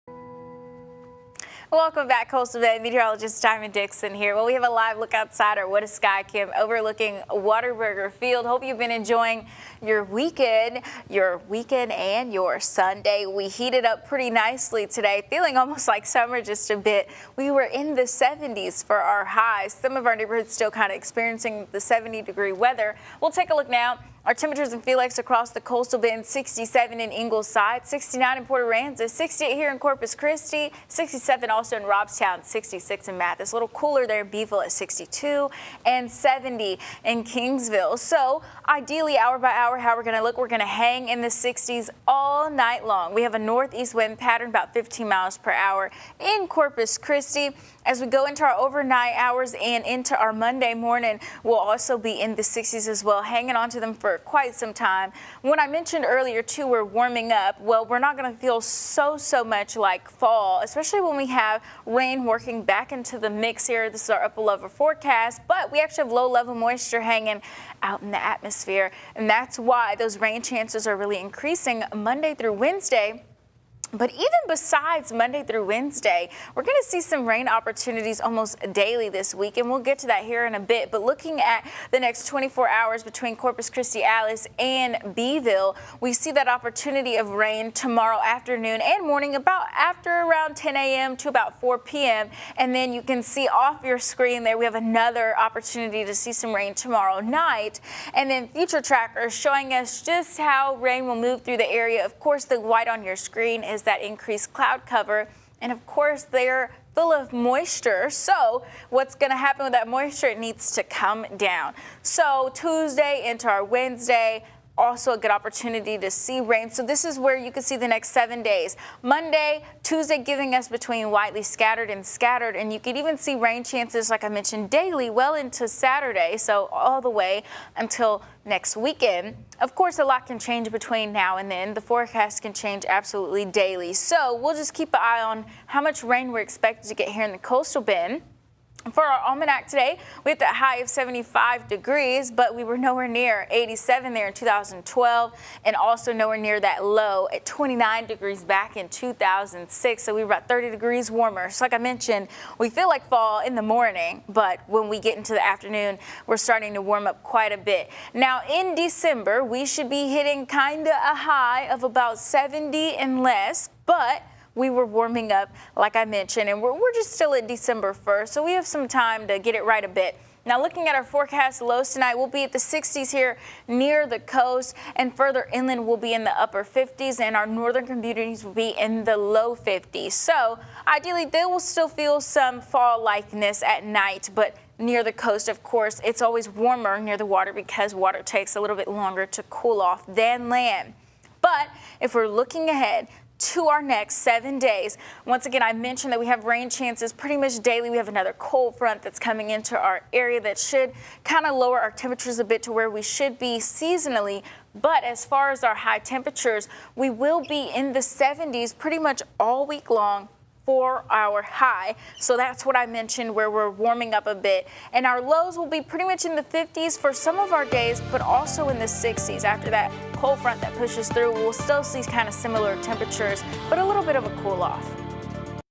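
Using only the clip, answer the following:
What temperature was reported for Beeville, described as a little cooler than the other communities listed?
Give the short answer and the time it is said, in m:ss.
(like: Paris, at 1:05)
62, at 0:34.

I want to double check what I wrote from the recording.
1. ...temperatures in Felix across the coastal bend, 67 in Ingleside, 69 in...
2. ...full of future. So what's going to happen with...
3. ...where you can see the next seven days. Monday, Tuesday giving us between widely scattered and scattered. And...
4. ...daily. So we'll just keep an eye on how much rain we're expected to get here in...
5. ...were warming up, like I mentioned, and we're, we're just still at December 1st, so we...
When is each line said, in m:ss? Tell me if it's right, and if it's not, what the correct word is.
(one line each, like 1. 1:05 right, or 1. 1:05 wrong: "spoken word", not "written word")
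1. 0:24 right
2. 1:46 wrong: "moisture", not "future"
3. 1:57 right
4. 2:13 right
5. 2:44 right.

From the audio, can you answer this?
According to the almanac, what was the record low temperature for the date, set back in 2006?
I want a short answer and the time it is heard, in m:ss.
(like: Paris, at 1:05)
29 degrees, at 2:27.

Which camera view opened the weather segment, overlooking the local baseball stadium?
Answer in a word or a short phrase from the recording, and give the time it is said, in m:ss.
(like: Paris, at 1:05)
What a Sky Cam, at 0:05.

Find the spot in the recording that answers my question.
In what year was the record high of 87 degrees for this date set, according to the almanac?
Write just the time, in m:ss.
2:24.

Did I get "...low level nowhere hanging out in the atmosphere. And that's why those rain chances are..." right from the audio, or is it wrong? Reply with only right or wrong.
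wrong.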